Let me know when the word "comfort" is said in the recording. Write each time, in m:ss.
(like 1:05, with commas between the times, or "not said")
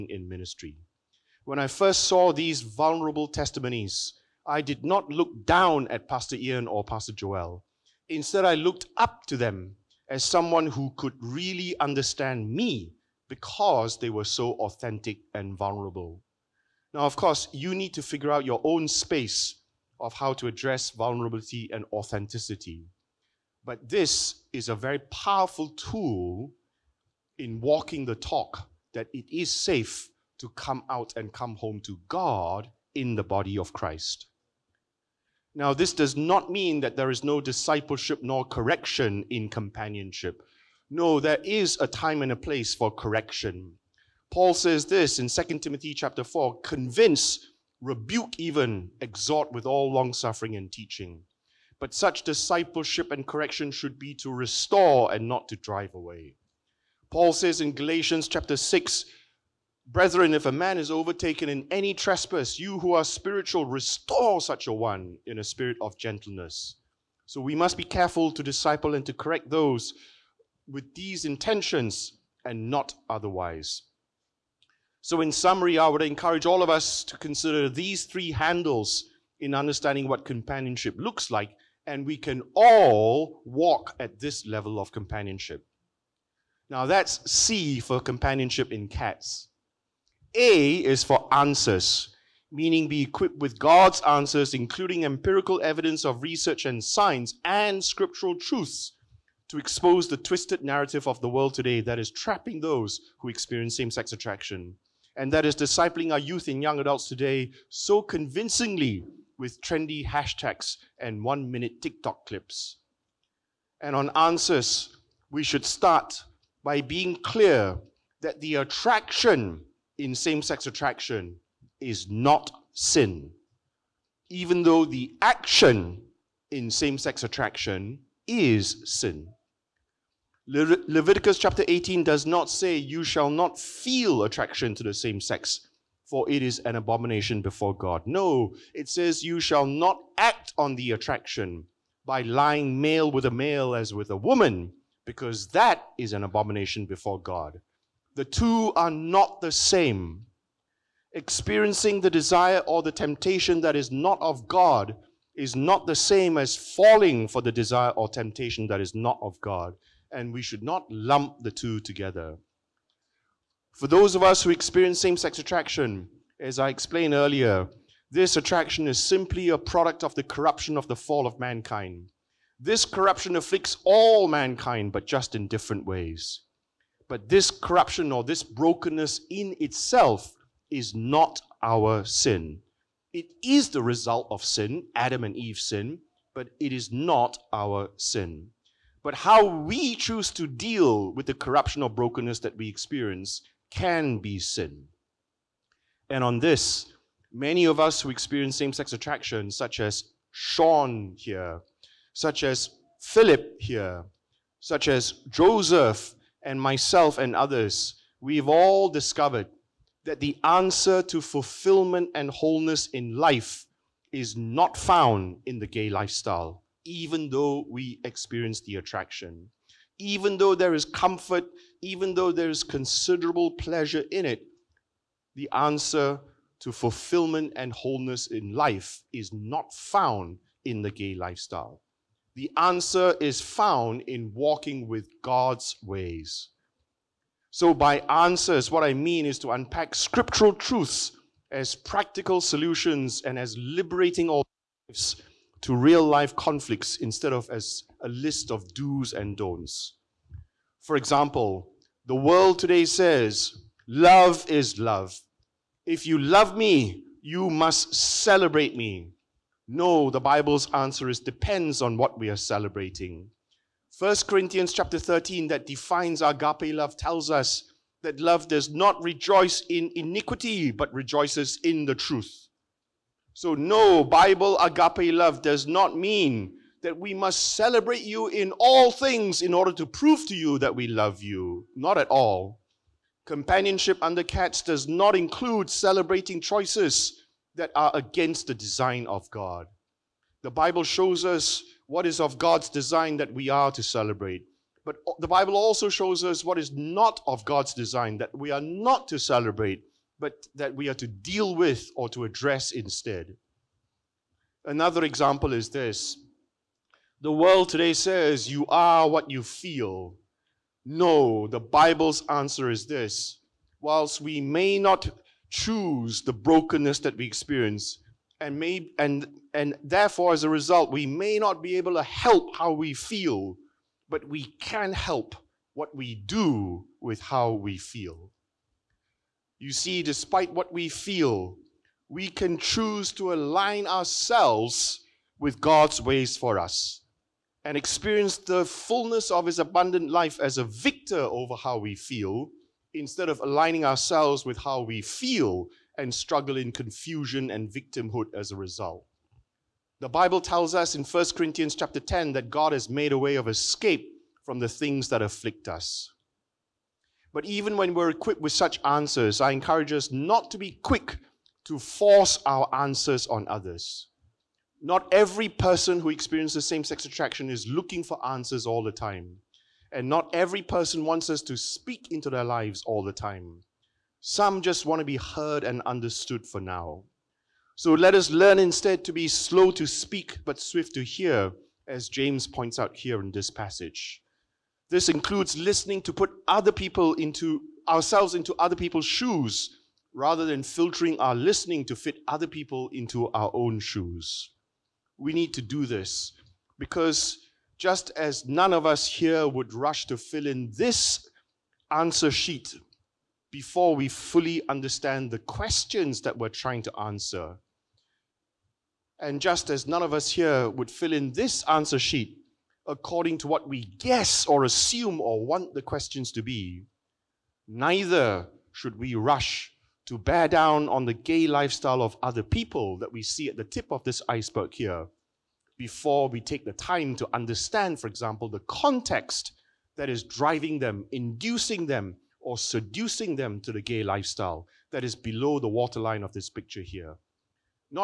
3:40.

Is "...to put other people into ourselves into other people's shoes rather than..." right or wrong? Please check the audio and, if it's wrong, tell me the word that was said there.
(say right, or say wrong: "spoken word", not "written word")
right.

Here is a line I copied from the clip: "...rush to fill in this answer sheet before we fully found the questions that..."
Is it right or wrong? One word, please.
wrong.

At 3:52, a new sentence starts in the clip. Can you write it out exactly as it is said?
The answer is found in walking with God's ways.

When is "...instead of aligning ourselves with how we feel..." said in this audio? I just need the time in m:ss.
5:42.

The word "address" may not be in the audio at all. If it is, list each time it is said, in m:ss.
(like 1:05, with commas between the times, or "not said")
0:20, 5:02.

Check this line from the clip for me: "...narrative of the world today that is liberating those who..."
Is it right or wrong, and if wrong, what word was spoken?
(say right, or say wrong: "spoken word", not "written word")
wrong: "trapping", not "liberating".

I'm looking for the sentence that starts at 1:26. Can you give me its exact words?
Now that's C for companionship in cats.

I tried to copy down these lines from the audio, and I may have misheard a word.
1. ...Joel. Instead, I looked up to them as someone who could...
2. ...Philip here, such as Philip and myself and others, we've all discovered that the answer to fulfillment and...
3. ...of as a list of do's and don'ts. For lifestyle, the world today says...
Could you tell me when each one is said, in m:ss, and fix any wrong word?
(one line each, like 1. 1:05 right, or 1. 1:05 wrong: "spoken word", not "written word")
1. 0:07 right
2. 3:23 wrong: "Joseph", not "Philip"
3. 4:07 wrong: "example", not "lifestyle".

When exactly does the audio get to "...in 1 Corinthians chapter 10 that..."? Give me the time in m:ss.
5:50.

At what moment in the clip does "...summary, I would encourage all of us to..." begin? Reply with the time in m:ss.
1:15.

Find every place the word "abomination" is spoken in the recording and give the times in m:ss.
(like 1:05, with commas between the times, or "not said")
2:16, 2:26.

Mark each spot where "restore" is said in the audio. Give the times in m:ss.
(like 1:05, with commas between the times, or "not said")
0:54, 1:03.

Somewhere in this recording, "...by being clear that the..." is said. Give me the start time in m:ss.
1:56.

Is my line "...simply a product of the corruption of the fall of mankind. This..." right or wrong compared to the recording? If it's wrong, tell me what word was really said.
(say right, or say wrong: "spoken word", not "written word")
right.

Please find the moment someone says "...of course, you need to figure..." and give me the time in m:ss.
0:17.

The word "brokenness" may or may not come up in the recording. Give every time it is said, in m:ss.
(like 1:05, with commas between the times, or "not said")
2:58, 3:11, 5:16.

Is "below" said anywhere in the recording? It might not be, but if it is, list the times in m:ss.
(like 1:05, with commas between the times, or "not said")
7:15.